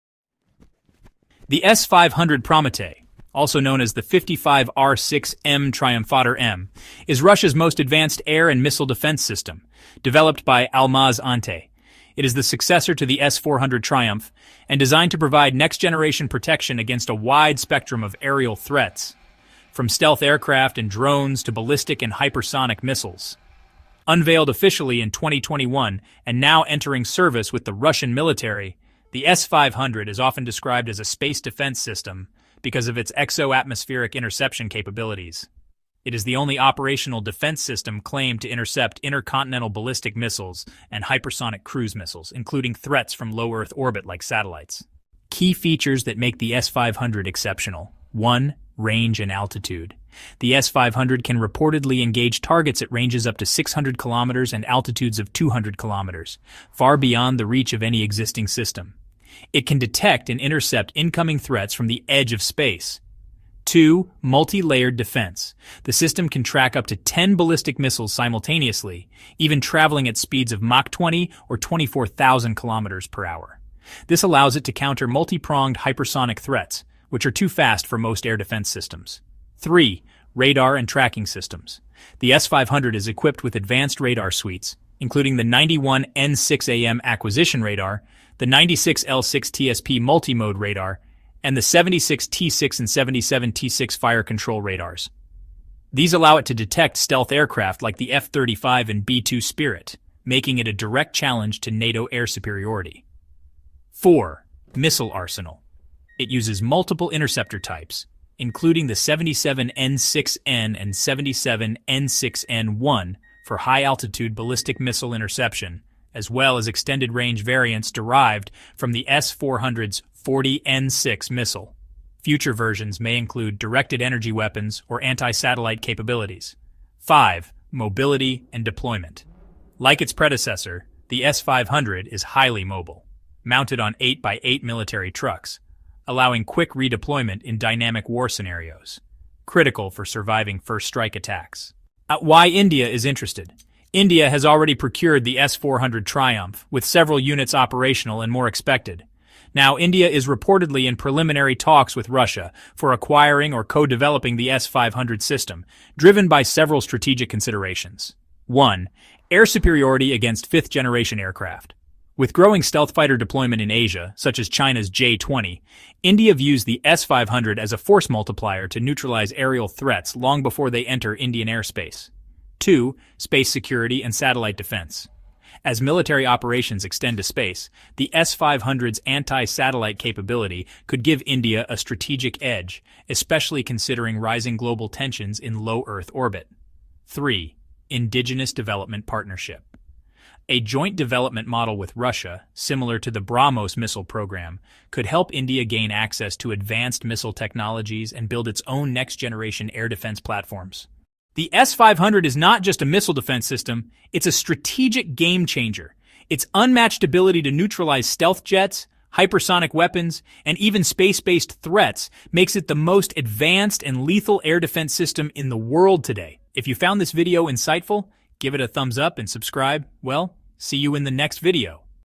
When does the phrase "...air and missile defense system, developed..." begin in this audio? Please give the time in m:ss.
0:08.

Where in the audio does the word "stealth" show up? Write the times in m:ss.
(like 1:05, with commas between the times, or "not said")
0:19, 1:36, 2:42, 3:28.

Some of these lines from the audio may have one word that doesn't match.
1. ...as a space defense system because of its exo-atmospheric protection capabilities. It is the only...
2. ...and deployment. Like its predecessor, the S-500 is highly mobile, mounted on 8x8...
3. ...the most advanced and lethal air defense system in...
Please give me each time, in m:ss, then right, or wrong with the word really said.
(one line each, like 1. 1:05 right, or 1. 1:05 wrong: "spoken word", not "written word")
1. 0:30 wrong: "interception", not "protection"
2. 2:08 right
3. 3:32 right.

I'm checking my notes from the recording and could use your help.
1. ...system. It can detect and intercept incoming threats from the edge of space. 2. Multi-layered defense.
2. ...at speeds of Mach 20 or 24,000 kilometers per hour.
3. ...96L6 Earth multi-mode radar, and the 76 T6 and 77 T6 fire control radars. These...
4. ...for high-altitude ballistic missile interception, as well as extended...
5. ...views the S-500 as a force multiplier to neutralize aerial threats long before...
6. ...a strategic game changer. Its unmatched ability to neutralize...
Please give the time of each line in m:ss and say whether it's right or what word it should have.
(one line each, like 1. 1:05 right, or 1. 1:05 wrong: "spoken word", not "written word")
1. 0:58 right
2. 1:10 right
3. 1:28 wrong: "TSP", not "Earth"
4. 1:53 right
5. 2:46 right
6. 3:24 right.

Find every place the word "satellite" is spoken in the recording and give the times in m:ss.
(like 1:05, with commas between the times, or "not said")
0:44, 2:05, 2:54, 2:59.